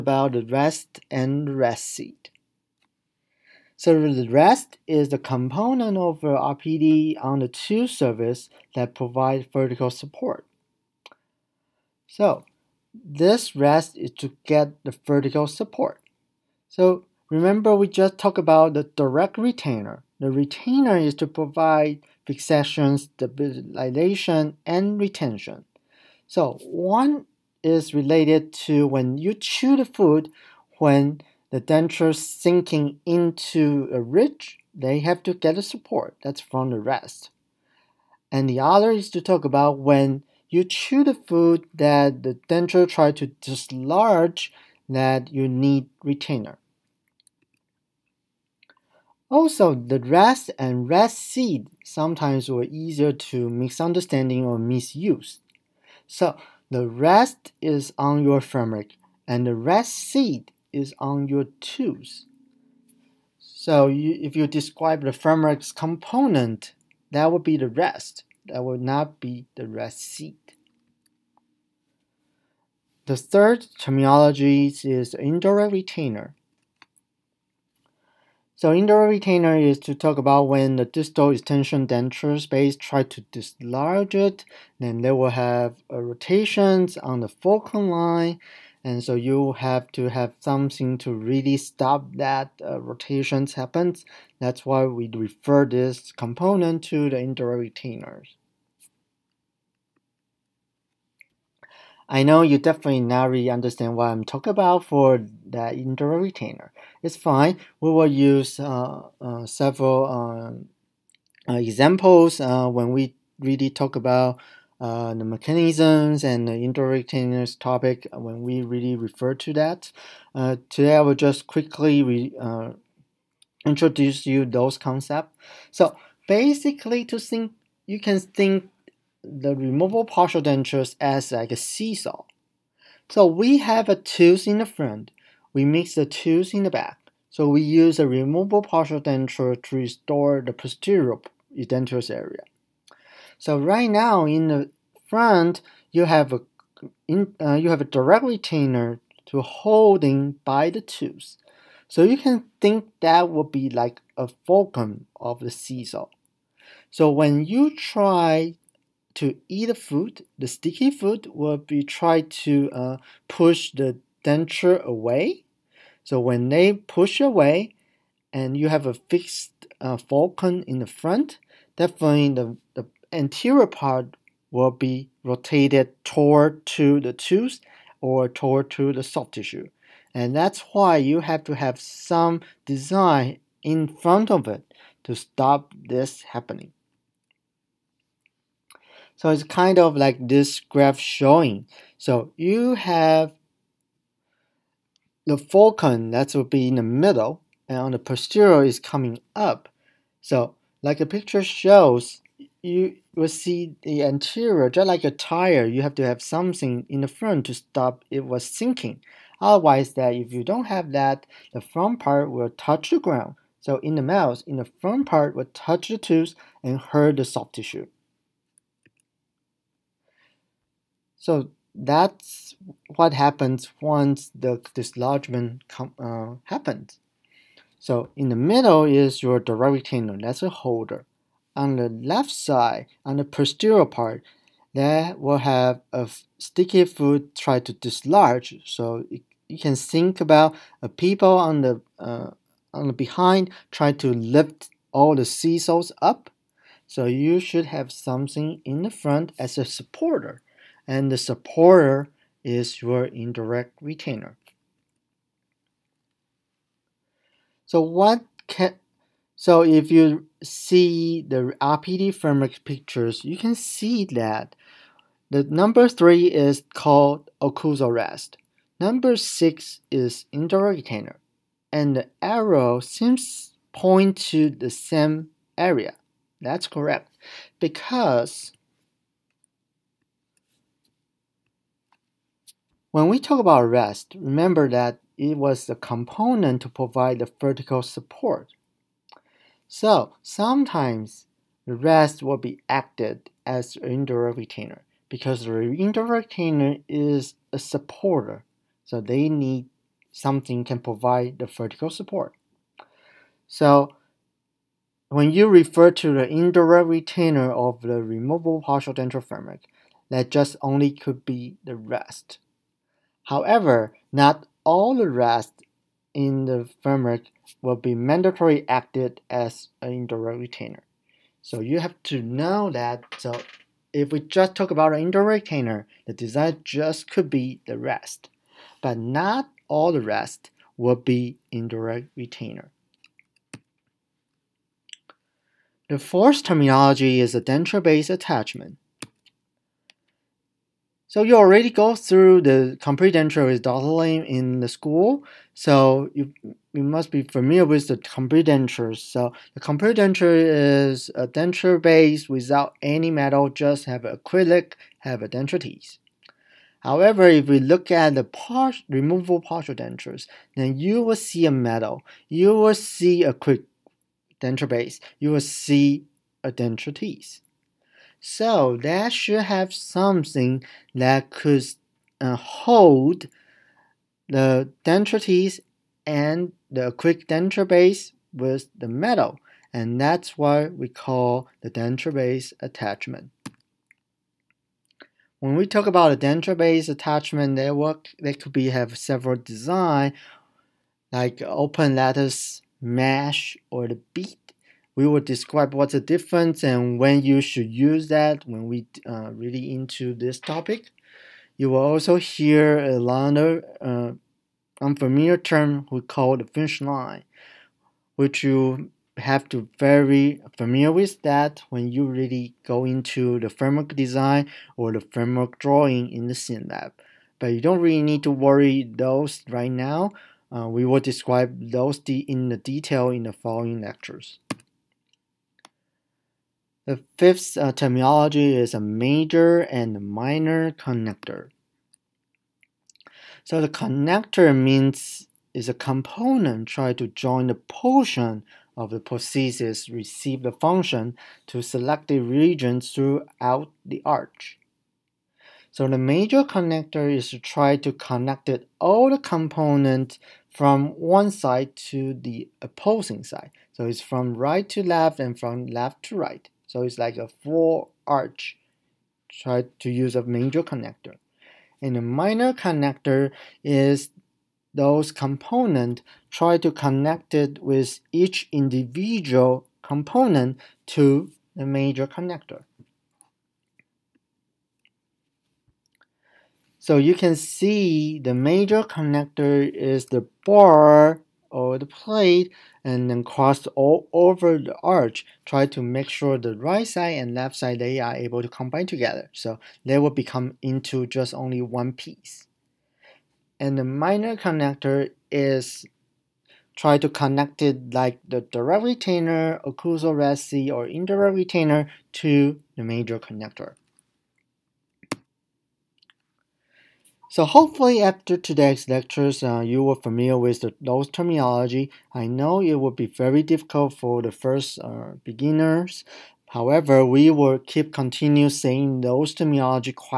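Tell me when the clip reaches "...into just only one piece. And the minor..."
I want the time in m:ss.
8:10.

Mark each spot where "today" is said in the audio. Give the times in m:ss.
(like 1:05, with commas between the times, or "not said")
2:00, 8:28.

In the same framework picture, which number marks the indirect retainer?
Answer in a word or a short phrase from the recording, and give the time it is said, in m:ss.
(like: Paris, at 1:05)
6, at 4:28.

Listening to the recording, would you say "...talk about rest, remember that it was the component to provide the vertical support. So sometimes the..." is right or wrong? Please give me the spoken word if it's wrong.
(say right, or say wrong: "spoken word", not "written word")
right.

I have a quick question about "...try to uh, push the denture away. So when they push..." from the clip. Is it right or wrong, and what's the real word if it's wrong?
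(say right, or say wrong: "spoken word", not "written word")
right.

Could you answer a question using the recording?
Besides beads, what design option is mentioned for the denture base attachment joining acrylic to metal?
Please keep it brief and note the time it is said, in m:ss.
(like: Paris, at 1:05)
Open lattice mesh, at 6:31.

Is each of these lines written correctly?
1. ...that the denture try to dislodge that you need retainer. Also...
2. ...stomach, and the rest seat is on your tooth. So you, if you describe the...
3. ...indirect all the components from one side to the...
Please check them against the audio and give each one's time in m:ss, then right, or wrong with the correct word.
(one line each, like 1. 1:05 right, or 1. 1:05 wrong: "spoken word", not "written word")
1. 0:41 right
2. 0:58 right
3. 7:27 wrong: "connect", not "indirect".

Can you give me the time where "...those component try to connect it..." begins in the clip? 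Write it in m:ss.
7:44.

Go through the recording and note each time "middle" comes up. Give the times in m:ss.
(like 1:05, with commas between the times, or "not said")
3:16, 3:48.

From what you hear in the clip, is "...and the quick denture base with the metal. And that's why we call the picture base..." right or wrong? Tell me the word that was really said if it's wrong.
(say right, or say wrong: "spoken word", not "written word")
wrong: "denture", not "picture".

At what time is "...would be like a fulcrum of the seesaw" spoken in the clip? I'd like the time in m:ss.
2:33.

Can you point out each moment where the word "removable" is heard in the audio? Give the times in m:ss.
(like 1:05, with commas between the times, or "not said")
2:09, 2:18, 5:08, 5:58.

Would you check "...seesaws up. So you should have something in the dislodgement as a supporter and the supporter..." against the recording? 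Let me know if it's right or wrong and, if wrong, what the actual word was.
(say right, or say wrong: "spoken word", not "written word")
wrong: "front", not "dislodgement".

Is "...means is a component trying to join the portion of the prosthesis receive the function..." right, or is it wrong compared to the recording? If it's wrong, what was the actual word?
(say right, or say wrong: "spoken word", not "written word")
right.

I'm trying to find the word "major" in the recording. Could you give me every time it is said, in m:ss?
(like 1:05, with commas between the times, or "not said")
7:08, 7:25, 7:40, 7:51, 7:58, 8:22.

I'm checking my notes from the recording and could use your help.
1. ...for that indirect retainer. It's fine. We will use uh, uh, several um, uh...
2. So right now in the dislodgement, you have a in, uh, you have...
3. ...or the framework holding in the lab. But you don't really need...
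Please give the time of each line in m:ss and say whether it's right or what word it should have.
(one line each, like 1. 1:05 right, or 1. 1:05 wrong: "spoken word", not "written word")
1. 1:44 right
2. 2:23 wrong: "front", not "dislodgement"
3. 6:54 wrong: "drawing", not "holding".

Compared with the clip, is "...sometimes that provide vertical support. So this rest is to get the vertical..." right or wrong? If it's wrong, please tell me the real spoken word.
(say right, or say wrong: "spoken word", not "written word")
wrong: "surfaces", not "sometimes".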